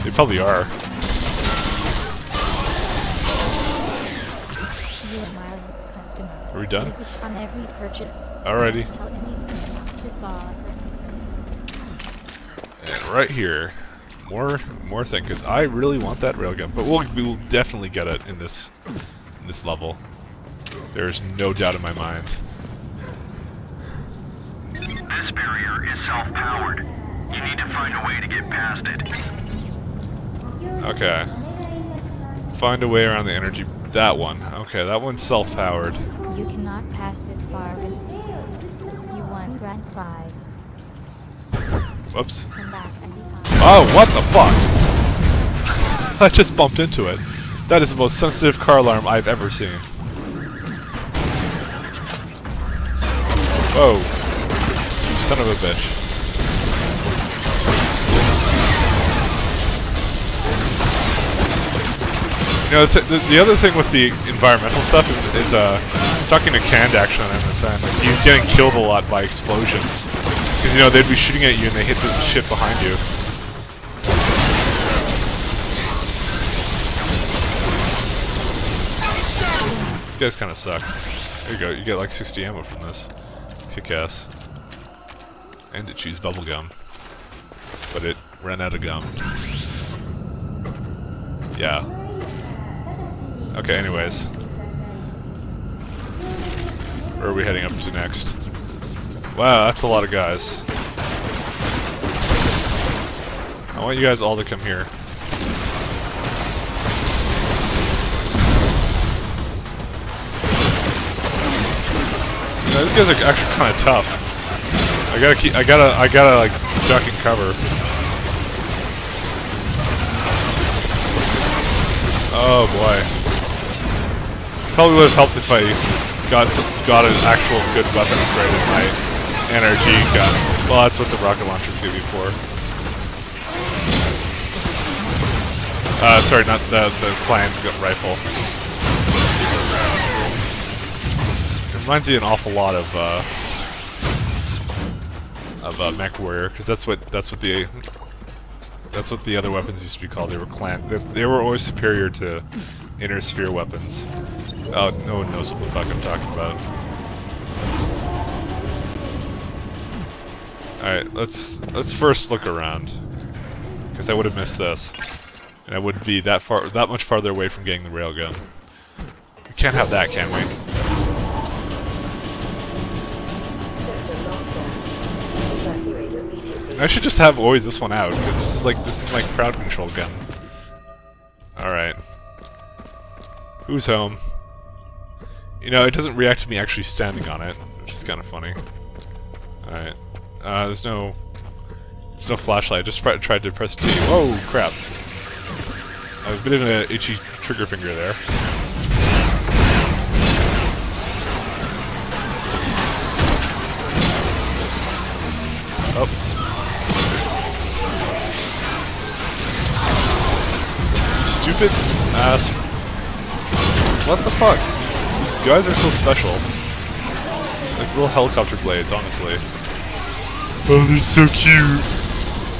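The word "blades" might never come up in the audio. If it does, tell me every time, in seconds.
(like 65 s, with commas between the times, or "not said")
218 s.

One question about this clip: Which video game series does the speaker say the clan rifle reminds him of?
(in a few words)
Mech Warrior.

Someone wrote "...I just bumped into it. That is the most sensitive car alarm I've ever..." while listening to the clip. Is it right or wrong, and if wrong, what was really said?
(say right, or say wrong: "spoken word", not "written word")
right.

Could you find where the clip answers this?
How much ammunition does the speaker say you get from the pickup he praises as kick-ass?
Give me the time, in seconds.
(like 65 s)
82 s.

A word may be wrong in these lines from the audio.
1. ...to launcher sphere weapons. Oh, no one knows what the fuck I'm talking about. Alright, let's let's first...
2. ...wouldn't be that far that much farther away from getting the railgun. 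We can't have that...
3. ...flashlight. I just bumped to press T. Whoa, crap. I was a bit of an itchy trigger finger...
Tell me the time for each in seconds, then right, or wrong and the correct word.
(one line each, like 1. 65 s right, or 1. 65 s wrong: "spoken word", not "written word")
1. 152 s wrong: "inner", not "launcher"
2. 165 s right
3. 192 s wrong: "tried", not "bumped".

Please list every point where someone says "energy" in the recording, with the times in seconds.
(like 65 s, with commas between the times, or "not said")
33 s, 129 s.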